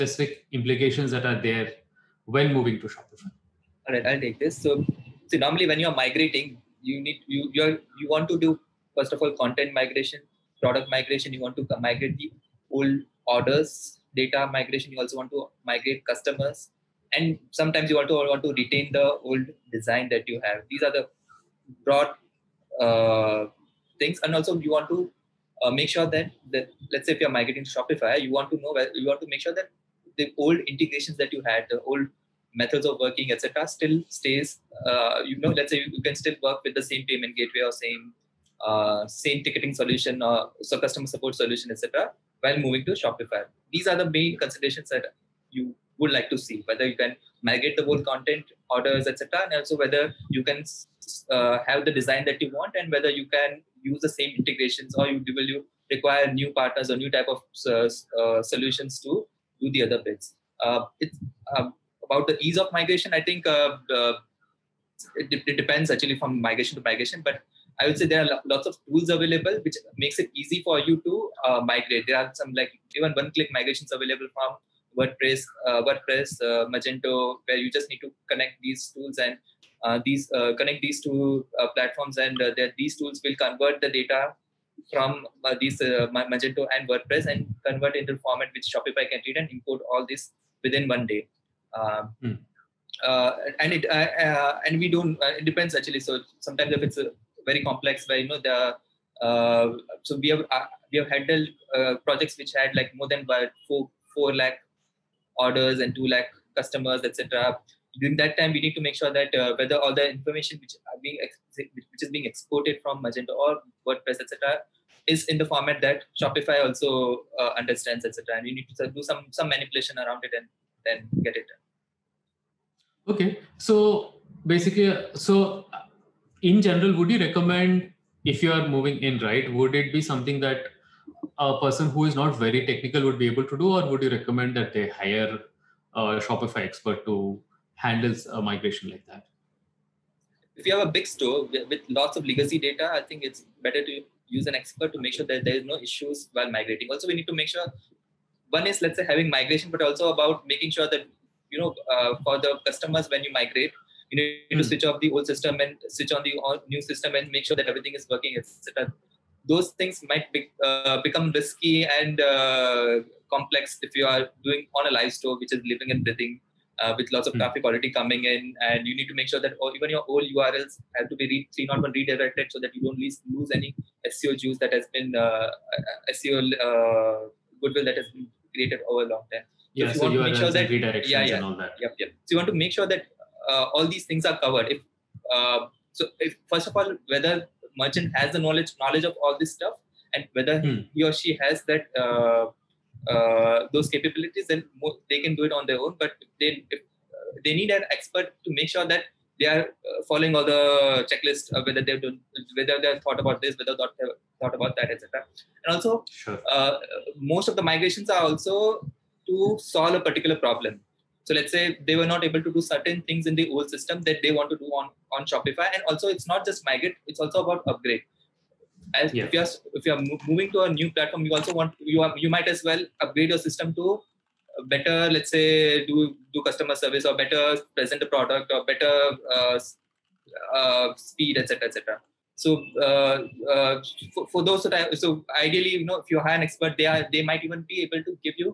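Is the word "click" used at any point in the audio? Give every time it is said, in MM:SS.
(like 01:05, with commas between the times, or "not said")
01:13.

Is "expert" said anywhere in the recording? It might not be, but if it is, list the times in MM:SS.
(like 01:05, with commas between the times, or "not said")
02:16, 02:24, 03:17, 03:56.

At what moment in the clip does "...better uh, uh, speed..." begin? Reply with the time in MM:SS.
03:48.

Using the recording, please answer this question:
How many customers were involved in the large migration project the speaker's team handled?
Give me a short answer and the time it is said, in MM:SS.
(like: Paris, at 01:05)
2 lakh, at 01:45.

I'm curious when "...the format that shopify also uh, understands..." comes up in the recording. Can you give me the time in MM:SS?
01:55.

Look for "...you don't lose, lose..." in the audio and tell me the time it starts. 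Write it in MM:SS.
02:52.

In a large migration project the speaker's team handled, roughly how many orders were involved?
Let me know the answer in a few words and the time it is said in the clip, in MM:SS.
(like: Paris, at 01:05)
4 lakh, at 01:43.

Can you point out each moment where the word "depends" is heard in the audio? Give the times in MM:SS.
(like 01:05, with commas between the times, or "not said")
01:05, 01:35.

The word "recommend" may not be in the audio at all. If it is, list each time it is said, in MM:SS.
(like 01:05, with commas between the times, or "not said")
02:07, 02:14.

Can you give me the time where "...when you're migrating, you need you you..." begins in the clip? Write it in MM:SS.
00:05.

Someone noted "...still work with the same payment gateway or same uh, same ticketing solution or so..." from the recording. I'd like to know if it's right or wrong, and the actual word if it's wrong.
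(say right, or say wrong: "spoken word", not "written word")
right.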